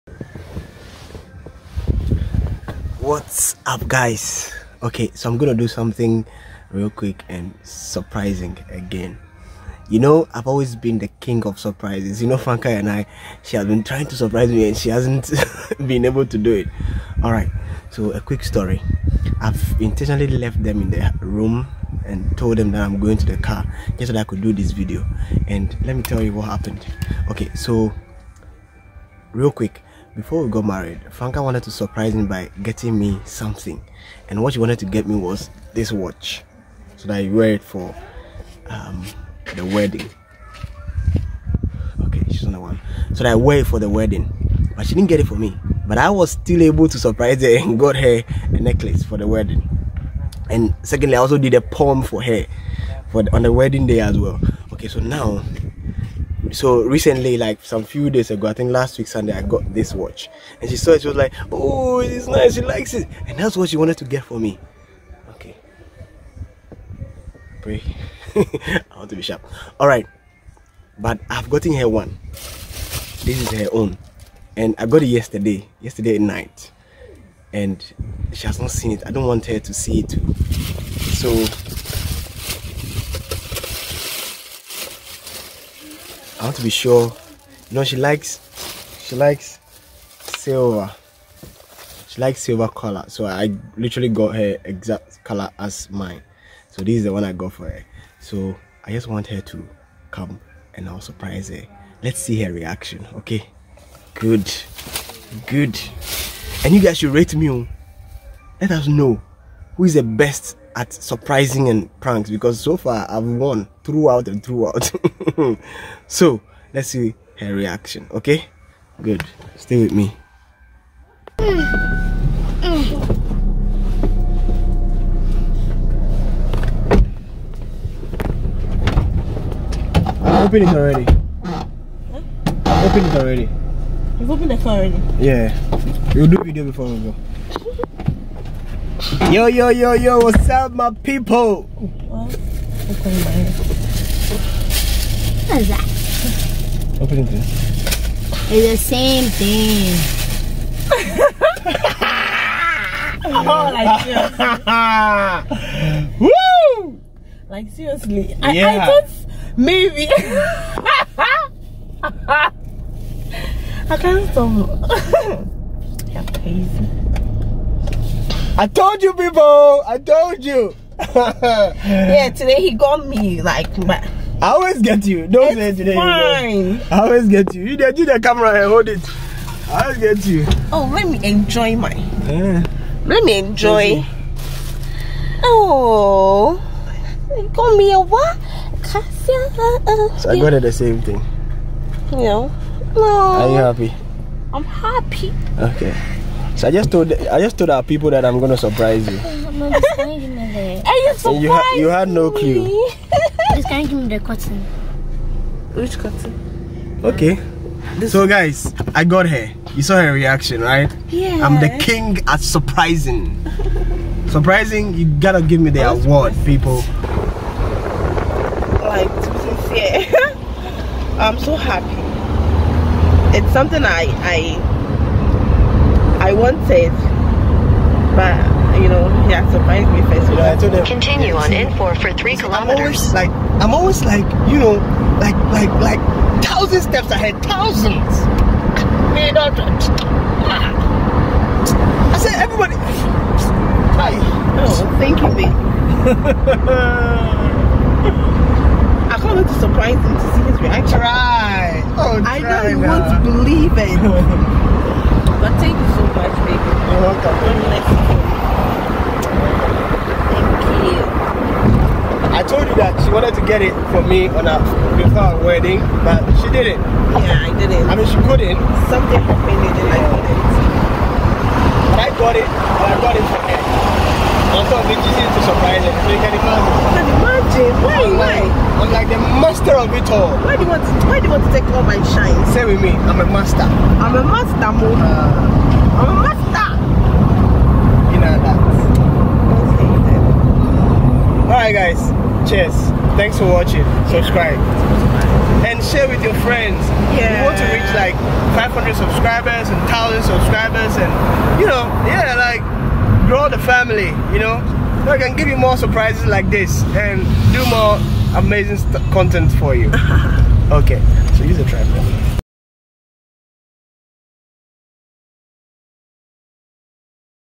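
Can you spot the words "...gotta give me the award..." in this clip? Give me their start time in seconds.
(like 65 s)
215 s.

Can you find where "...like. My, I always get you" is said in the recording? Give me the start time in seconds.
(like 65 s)
173 s.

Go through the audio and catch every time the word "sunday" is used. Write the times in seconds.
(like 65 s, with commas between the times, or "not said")
59 s.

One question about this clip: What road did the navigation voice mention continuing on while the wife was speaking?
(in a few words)
N4.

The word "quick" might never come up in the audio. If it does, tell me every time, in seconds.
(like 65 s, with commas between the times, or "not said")
6 s, 18 s, 29 s.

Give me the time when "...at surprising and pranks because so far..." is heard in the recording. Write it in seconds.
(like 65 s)
110 s.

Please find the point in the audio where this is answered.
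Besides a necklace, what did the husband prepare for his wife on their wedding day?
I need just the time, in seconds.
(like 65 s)
51 s.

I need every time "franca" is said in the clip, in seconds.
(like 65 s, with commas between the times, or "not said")
12 s, 31 s.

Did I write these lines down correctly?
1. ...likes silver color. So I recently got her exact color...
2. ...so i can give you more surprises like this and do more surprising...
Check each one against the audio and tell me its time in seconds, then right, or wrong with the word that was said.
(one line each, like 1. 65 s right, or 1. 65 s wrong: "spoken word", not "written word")
1. 92 s wrong: "literally", not "recently"
2. 305 s wrong: "amazing", not "surprising".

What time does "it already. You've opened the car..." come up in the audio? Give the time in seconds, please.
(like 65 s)
132 s.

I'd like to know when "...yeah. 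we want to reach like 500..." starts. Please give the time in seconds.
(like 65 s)
297 s.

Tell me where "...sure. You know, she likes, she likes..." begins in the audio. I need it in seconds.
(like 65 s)
86 s.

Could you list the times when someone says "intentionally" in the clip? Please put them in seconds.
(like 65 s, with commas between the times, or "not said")
19 s.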